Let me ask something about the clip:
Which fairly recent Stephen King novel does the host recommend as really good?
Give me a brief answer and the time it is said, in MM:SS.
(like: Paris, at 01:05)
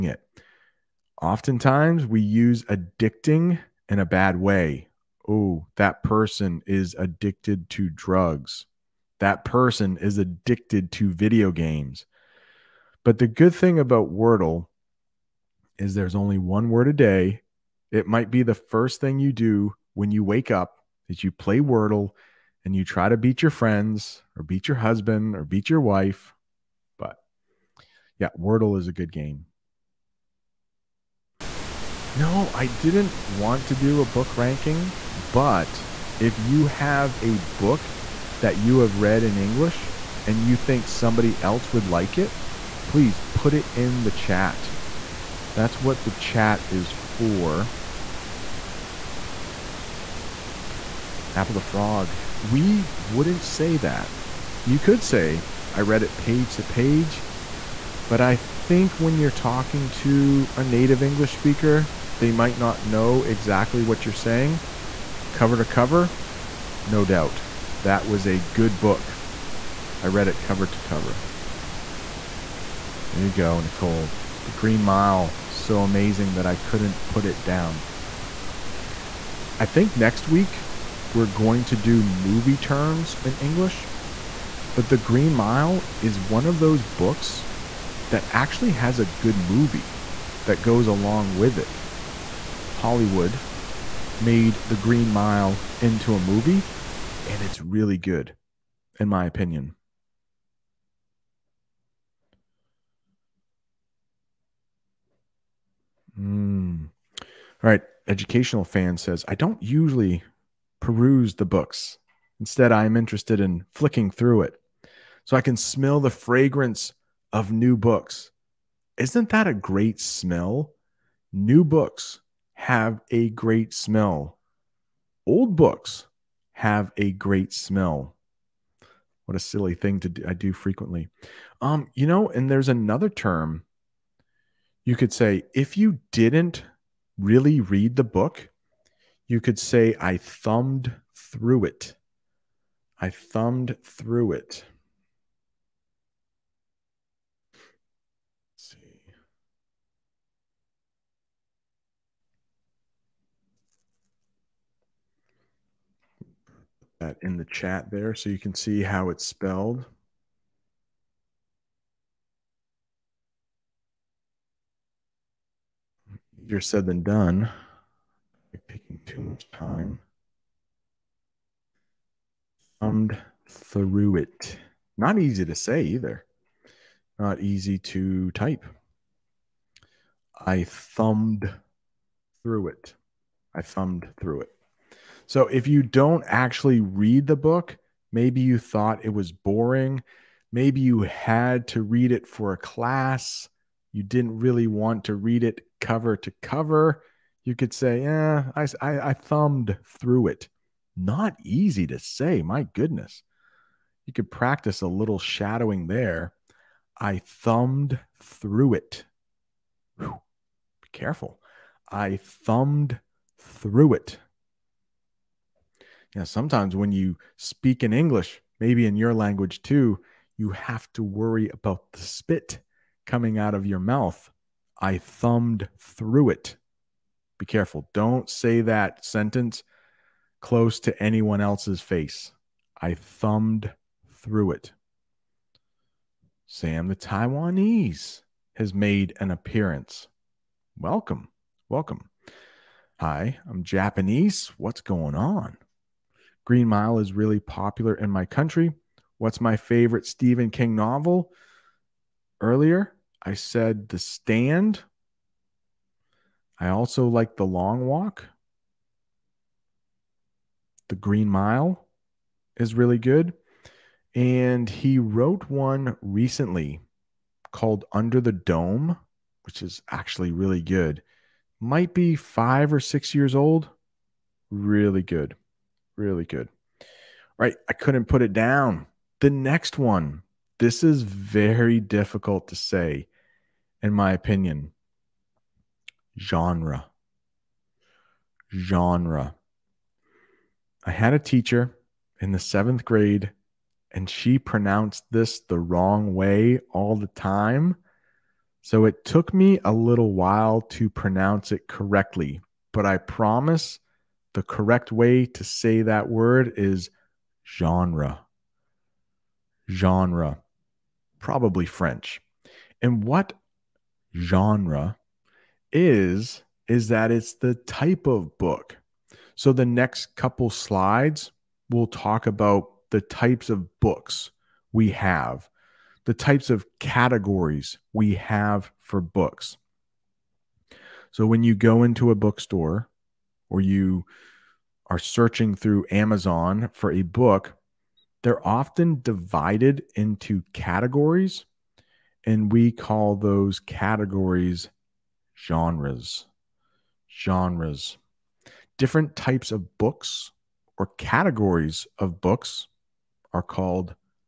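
Under the Dome, at 04:27.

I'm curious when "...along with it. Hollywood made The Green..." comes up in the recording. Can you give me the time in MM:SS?
01:30.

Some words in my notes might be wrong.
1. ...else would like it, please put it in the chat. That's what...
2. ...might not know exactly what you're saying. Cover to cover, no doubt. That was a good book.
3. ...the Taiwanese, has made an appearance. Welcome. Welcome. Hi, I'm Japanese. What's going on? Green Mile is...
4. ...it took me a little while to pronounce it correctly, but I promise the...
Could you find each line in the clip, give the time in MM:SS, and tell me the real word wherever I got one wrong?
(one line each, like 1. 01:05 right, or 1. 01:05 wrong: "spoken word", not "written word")
1. 00:41 right
2. 01:02 right
3. 03:56 right
4. 04:58 right.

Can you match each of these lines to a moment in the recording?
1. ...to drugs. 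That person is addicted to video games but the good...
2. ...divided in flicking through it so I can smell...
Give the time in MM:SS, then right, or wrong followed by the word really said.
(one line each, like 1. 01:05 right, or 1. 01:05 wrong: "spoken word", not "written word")
1. 00:07 right
2. 01:52 wrong: "interested", not "divided".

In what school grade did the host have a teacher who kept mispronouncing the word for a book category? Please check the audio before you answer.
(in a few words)
Seventh grade.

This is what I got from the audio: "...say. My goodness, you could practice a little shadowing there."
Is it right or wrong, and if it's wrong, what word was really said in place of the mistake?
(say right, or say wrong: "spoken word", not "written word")
right.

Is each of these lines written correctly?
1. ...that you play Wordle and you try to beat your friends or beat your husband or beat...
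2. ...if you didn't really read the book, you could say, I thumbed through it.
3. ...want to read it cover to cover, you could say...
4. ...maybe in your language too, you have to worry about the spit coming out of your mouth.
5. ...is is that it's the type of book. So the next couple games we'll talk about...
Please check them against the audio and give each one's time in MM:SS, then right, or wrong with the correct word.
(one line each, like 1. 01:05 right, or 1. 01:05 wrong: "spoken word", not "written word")
1. 00:21 right
2. 02:15 right
3. 03:14 right
4. 03:38 right
5. 05:15 wrong: "slides", not "games".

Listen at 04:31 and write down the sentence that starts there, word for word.
Might be five or six years old.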